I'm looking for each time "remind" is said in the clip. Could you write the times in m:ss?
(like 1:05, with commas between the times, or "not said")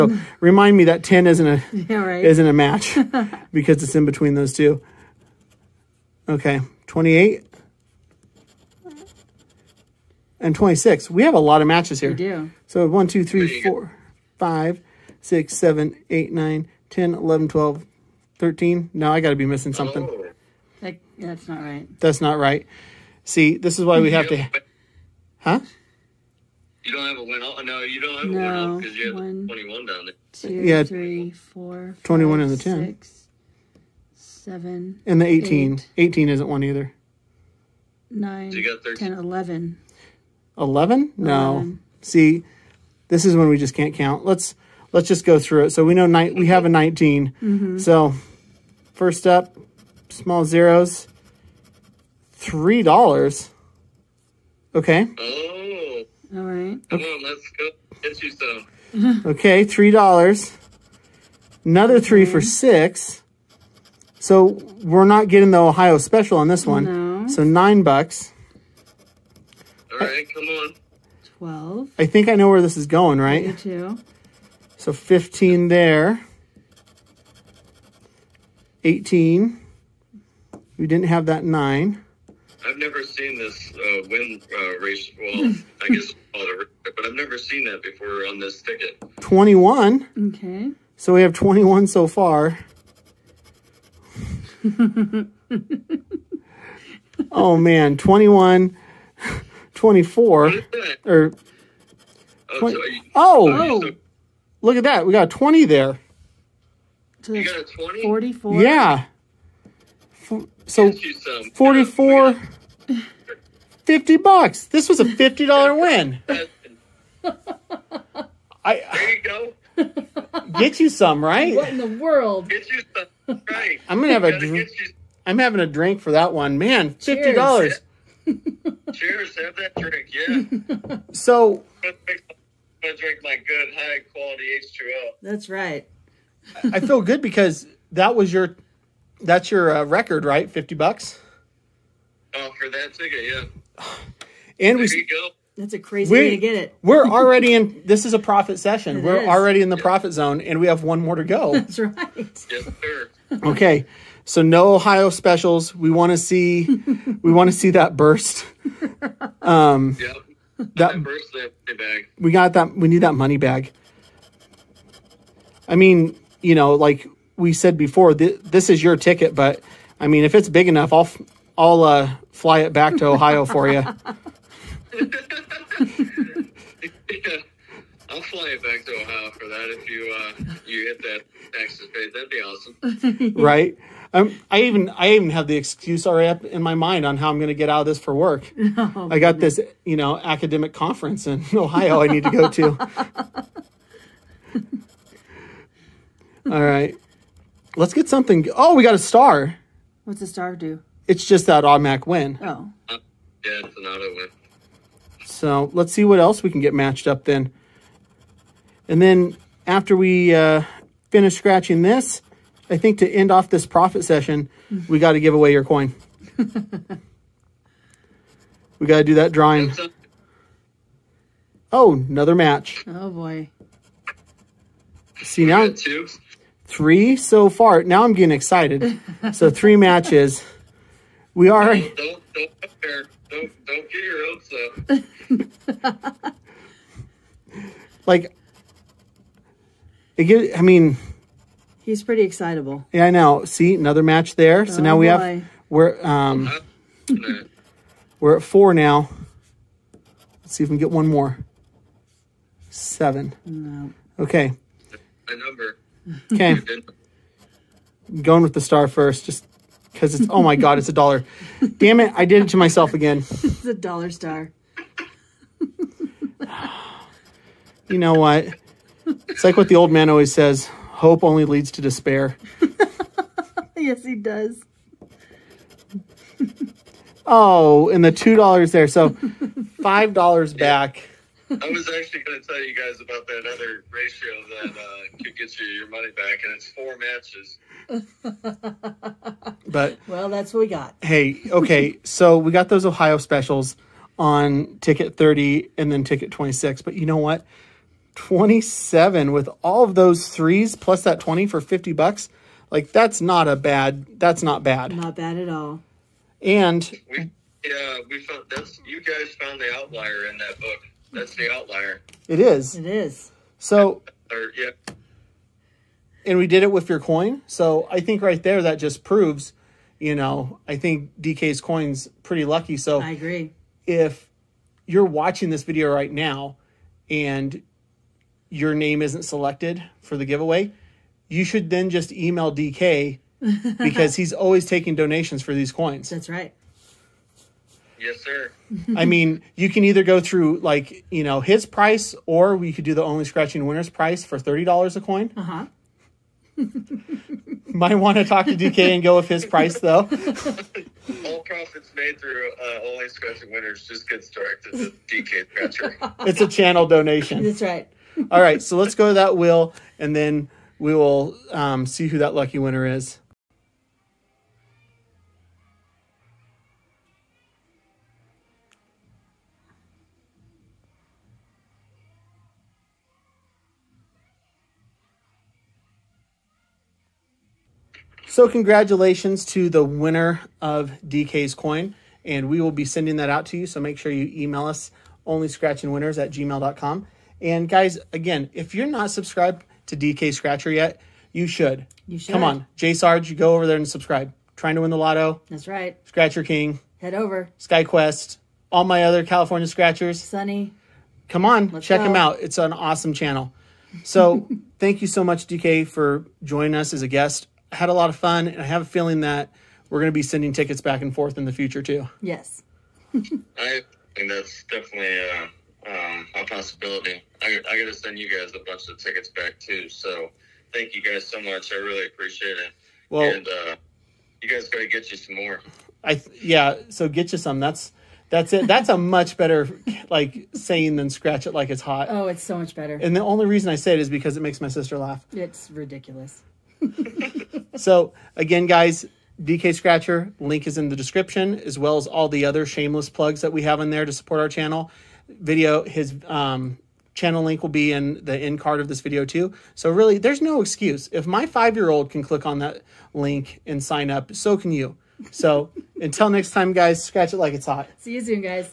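0:00.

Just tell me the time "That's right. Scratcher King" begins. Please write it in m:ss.
6:35.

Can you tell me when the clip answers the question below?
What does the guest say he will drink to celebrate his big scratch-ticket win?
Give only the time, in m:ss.
2:14.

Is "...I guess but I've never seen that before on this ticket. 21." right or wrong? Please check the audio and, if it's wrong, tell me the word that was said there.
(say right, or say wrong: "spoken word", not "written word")
right.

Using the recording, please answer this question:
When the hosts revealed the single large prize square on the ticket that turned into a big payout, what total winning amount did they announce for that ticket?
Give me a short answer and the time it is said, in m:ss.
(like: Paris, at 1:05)
$50, at 1:53.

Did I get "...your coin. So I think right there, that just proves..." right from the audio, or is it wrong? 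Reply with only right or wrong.
right.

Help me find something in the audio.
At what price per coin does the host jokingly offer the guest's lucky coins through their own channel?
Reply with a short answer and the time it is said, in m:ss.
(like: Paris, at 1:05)
$30, at 5:44.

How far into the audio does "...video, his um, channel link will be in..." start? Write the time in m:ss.
7:25.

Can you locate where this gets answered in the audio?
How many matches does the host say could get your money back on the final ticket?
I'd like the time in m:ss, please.
4:46.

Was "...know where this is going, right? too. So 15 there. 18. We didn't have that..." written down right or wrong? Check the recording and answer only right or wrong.
right.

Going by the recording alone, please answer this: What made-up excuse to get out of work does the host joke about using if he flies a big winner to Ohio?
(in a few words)
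academic conference.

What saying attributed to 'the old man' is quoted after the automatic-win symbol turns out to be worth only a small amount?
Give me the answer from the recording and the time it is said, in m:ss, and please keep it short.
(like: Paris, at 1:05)
Hope only leads to despair, at 4:31.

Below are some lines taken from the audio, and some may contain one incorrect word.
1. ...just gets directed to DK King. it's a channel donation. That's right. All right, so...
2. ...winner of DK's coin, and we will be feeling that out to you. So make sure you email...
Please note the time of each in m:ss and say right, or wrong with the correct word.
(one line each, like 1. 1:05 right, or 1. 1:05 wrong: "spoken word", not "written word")
1. 5:53 wrong: "Scratcher", not "King"
2. 6:19 wrong: "sending", not "feeling".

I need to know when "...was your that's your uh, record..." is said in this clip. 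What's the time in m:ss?
2:18.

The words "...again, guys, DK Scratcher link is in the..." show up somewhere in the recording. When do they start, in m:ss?
7:18.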